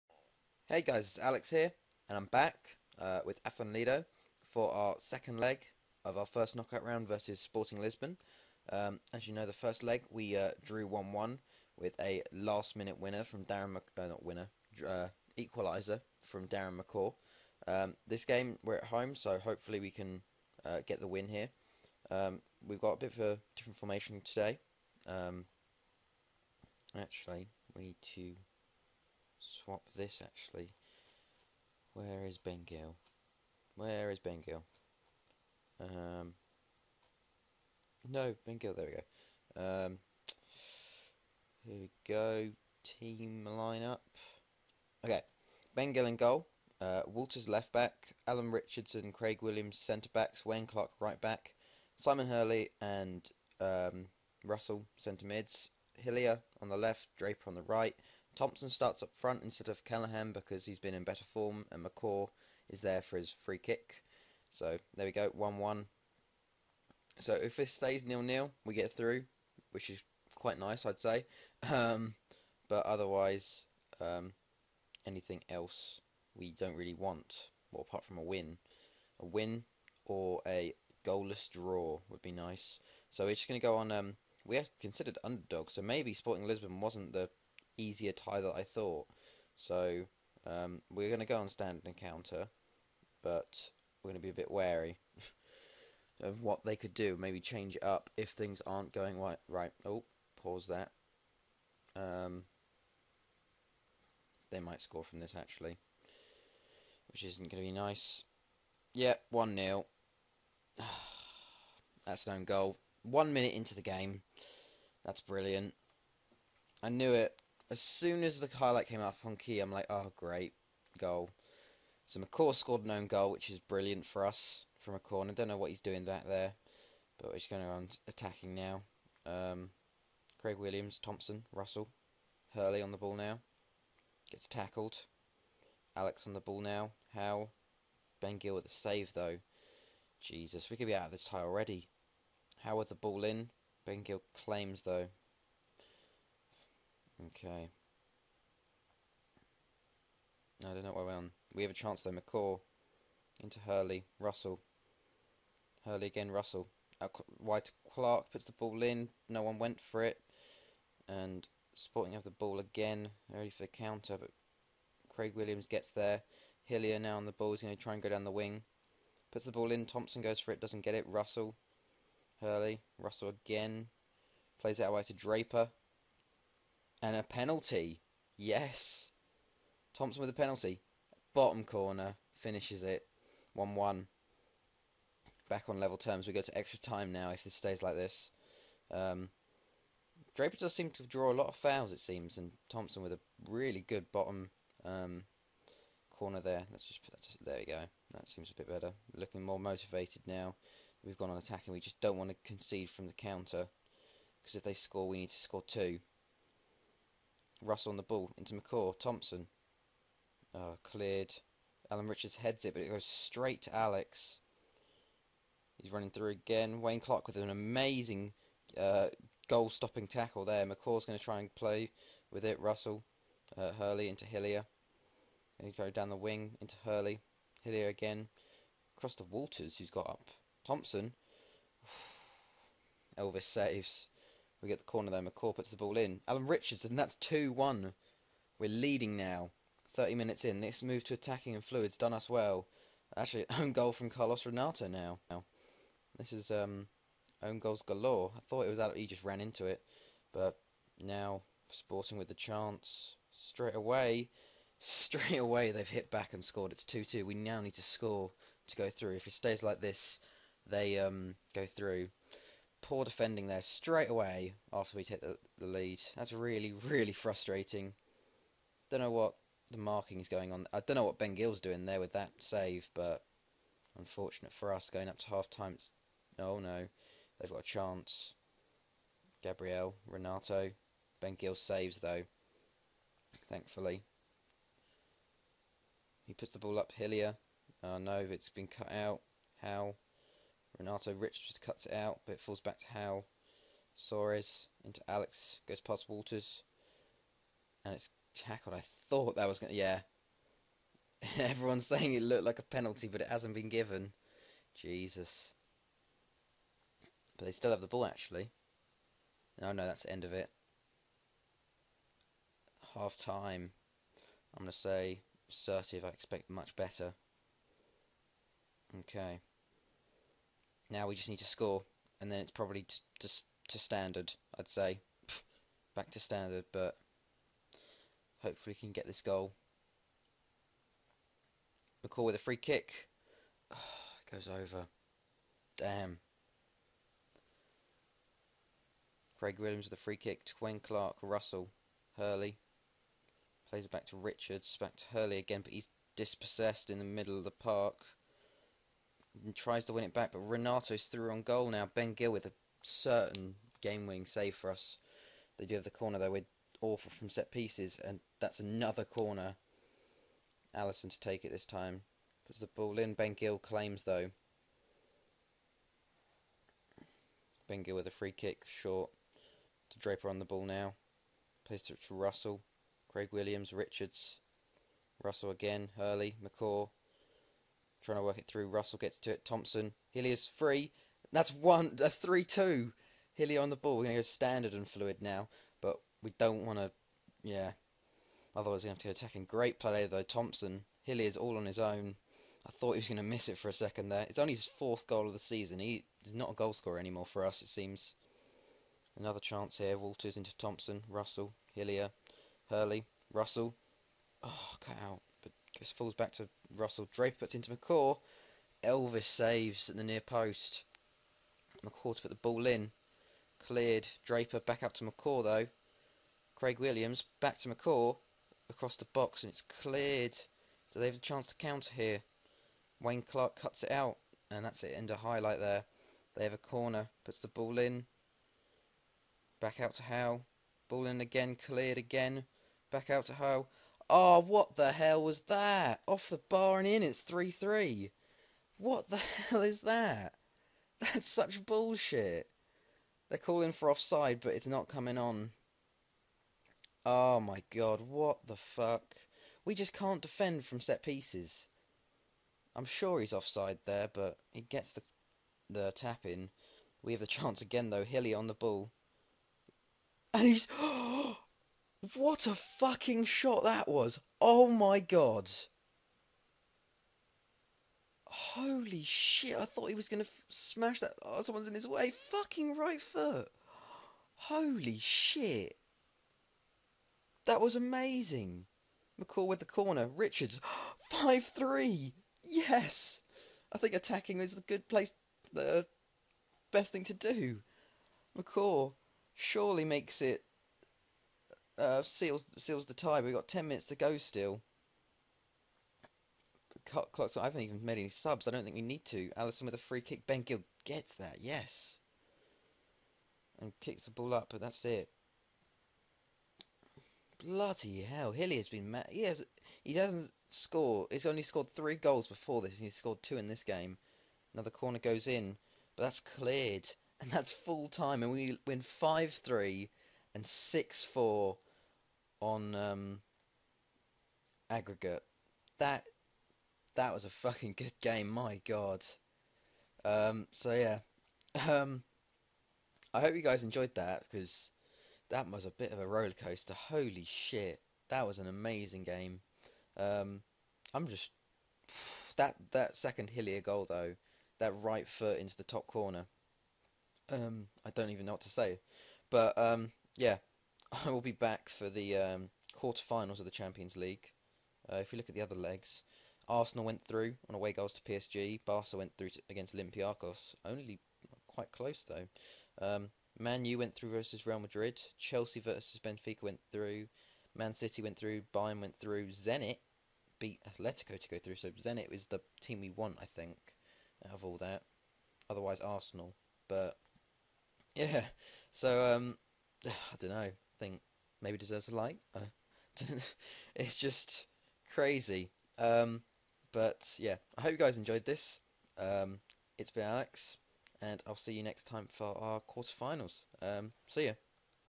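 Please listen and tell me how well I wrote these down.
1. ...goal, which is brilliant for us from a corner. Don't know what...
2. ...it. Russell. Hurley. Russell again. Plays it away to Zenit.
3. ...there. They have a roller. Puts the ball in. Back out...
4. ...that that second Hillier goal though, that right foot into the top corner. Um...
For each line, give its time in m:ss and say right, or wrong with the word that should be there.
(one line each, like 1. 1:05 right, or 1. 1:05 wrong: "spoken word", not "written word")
1. 2:03 right
2. 2:50 wrong: "Draper", not "Zenit"
3. 7:05 wrong: "corner", not "roller"
4. 9:02 right.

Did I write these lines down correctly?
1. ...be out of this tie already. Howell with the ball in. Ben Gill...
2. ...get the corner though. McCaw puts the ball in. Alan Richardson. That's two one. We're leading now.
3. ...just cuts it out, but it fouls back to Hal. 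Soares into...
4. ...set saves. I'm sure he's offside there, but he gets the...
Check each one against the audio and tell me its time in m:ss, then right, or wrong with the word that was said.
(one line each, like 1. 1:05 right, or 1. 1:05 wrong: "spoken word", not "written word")
1. 2:20 right
2. 3:54 right
3. 4:51 wrong: "falls", not "fouls"
4. 7:30 wrong: "pieces", not "saves".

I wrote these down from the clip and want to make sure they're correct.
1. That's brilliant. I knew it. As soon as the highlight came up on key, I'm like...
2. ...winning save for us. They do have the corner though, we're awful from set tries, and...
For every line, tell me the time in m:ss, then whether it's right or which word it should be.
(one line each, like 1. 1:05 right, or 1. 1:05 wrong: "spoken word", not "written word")
1. 1:55 right
2. 5:54 wrong: "pieces", not "tries".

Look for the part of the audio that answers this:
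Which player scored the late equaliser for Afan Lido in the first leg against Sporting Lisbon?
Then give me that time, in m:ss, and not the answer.
0:16.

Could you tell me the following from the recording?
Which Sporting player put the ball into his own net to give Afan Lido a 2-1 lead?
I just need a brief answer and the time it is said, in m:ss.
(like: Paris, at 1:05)
Carlos Renato, at 4:04.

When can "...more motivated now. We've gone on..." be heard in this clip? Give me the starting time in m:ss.
3:19.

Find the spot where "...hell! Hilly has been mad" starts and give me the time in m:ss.
8:28.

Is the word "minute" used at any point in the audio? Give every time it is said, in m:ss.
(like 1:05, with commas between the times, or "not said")
0:12, 1:53, 4:00, 8:13.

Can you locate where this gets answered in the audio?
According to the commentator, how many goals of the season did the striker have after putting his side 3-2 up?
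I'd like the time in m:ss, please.
6:34.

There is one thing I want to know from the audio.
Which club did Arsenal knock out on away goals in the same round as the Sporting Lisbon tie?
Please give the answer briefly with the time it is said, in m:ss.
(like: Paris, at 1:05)
PSG, at 9:18.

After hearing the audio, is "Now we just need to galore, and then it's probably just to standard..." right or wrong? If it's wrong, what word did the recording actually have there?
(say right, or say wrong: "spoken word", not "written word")
wrong: "score", not "galore".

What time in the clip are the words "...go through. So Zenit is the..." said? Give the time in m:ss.
9:31.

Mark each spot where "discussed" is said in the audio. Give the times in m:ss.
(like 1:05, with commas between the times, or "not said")
not said.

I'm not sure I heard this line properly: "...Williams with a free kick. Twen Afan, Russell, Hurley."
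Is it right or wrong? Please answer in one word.
wrong.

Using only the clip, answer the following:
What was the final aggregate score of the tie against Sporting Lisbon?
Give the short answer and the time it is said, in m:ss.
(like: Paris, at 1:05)
6-4, at 8:40.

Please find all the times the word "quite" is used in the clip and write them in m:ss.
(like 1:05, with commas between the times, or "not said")
1:10, 9:21.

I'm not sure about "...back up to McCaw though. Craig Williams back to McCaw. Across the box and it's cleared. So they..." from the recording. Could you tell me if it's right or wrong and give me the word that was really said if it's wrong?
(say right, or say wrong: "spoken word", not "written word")
right.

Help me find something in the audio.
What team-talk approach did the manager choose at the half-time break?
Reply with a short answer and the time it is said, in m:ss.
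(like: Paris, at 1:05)
assertive, at 5:15.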